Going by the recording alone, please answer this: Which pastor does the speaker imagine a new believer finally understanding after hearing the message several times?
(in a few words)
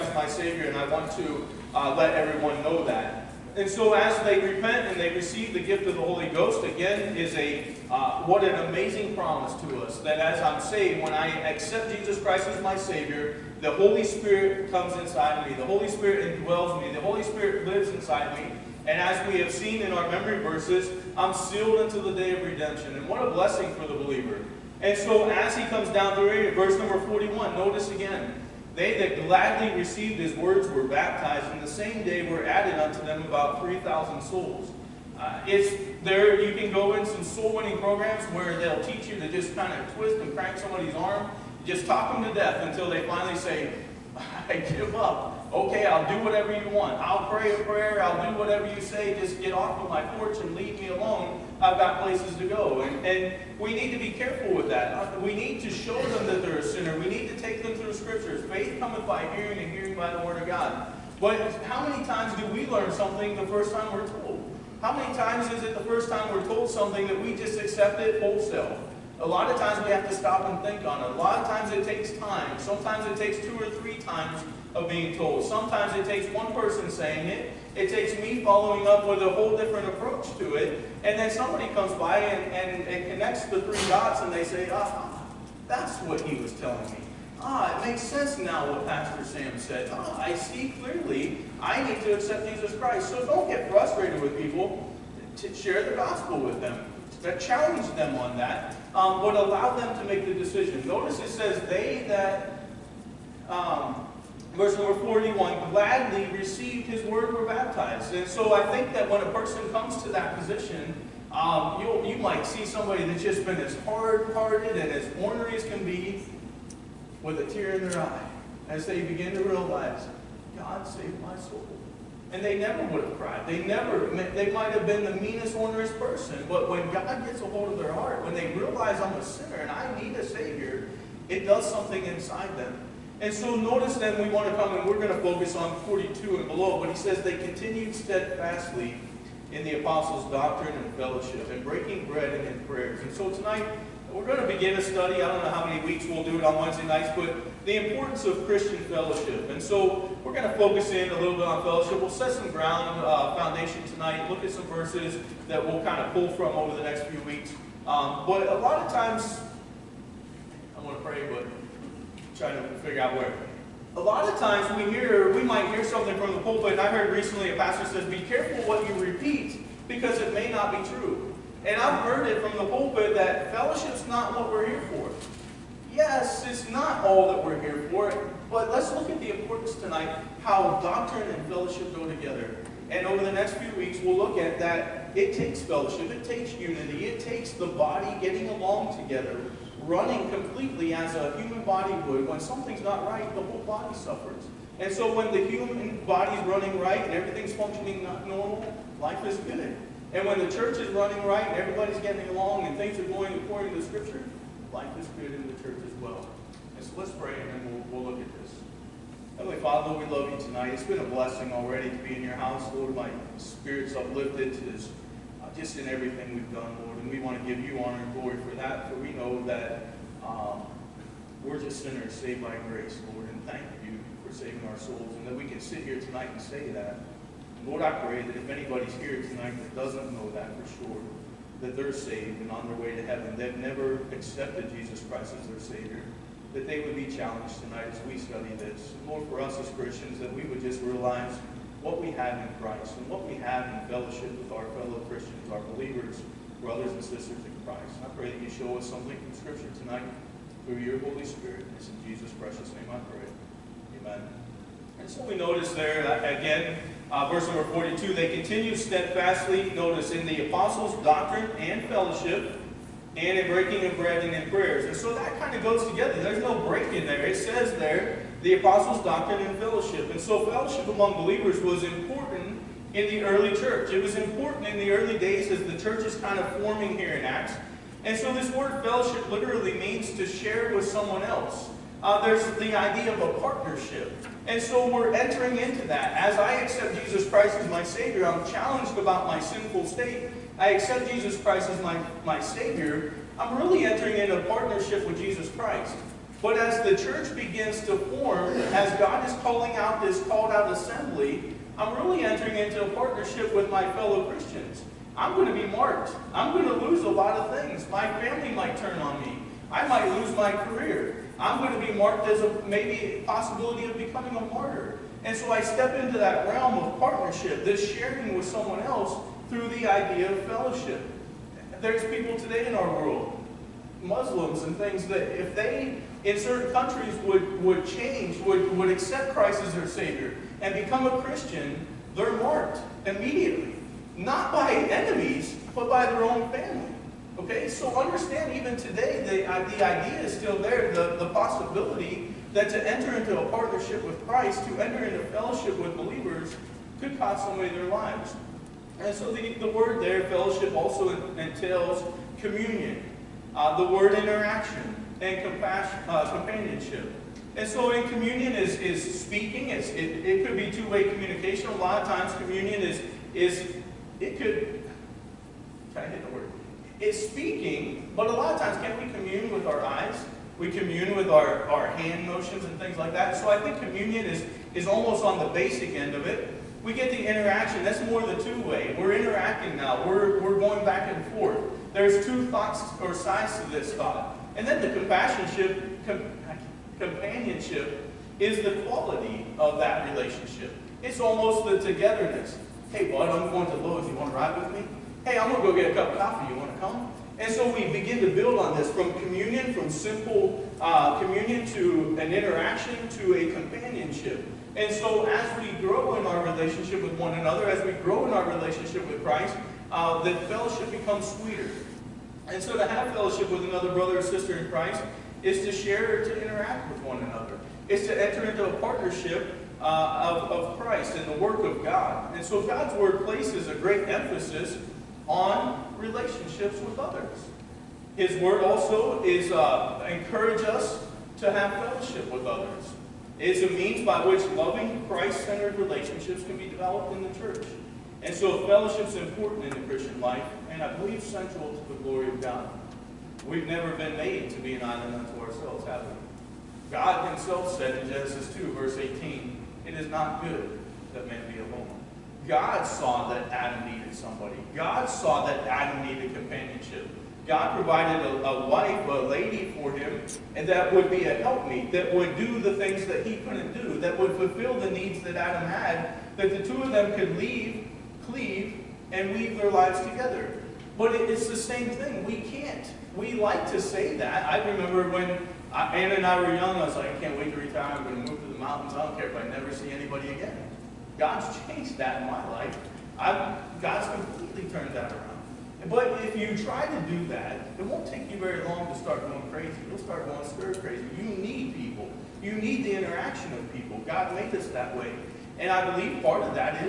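Pastor Sam.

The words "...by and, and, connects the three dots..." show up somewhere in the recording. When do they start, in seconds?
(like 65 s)
81 s.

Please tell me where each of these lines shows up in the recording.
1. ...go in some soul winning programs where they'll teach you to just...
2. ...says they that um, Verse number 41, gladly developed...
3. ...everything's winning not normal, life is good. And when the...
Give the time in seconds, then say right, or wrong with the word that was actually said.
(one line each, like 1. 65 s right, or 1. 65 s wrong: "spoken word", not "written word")
1. 36 s right
2. 101 s wrong: "received", not "developed"
3. 197 s wrong: "functioning", not "winning".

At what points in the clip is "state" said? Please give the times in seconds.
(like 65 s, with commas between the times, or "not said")
289 s.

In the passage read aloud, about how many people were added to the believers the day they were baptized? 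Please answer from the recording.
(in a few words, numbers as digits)
3,000.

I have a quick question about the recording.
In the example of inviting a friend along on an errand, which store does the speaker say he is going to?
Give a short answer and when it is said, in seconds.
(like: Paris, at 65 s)
Lowe's, at 393 s.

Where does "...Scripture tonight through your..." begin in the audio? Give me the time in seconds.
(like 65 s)
249 s.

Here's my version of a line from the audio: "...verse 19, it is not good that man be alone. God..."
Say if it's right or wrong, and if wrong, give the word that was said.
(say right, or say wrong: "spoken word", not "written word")
wrong: "18", not "19".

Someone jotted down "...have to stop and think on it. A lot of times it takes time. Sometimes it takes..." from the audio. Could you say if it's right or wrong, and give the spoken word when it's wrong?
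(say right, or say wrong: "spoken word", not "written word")
right.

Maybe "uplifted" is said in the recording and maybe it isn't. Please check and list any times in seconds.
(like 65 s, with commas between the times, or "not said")
213 s.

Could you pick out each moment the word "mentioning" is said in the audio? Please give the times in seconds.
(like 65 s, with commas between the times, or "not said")
not said.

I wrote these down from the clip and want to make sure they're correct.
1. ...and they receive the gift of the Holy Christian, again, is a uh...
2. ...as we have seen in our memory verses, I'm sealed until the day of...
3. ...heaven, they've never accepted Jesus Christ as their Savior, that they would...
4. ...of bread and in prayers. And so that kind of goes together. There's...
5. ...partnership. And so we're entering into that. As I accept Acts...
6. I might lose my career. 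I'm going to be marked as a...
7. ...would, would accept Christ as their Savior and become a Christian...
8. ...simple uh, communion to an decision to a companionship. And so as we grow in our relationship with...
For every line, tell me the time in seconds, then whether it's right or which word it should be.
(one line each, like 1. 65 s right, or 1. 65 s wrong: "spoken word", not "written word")
1. 4 s wrong: "Ghost", not "Christian"
2. 18 s right
3. 233 s right
4. 263 s right
5. 283 s wrong: "Jesus", not "Acts"
6. 309 s right
7. 328 s right
8. 399 s wrong: "interaction", not "decision".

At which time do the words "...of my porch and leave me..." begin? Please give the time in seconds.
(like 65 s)
49 s.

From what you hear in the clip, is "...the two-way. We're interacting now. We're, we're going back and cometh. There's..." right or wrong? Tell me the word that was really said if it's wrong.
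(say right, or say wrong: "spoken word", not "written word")
wrong: "forth", not "cometh".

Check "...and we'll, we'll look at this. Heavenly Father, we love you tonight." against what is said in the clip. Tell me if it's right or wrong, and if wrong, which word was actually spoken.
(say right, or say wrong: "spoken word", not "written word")
right.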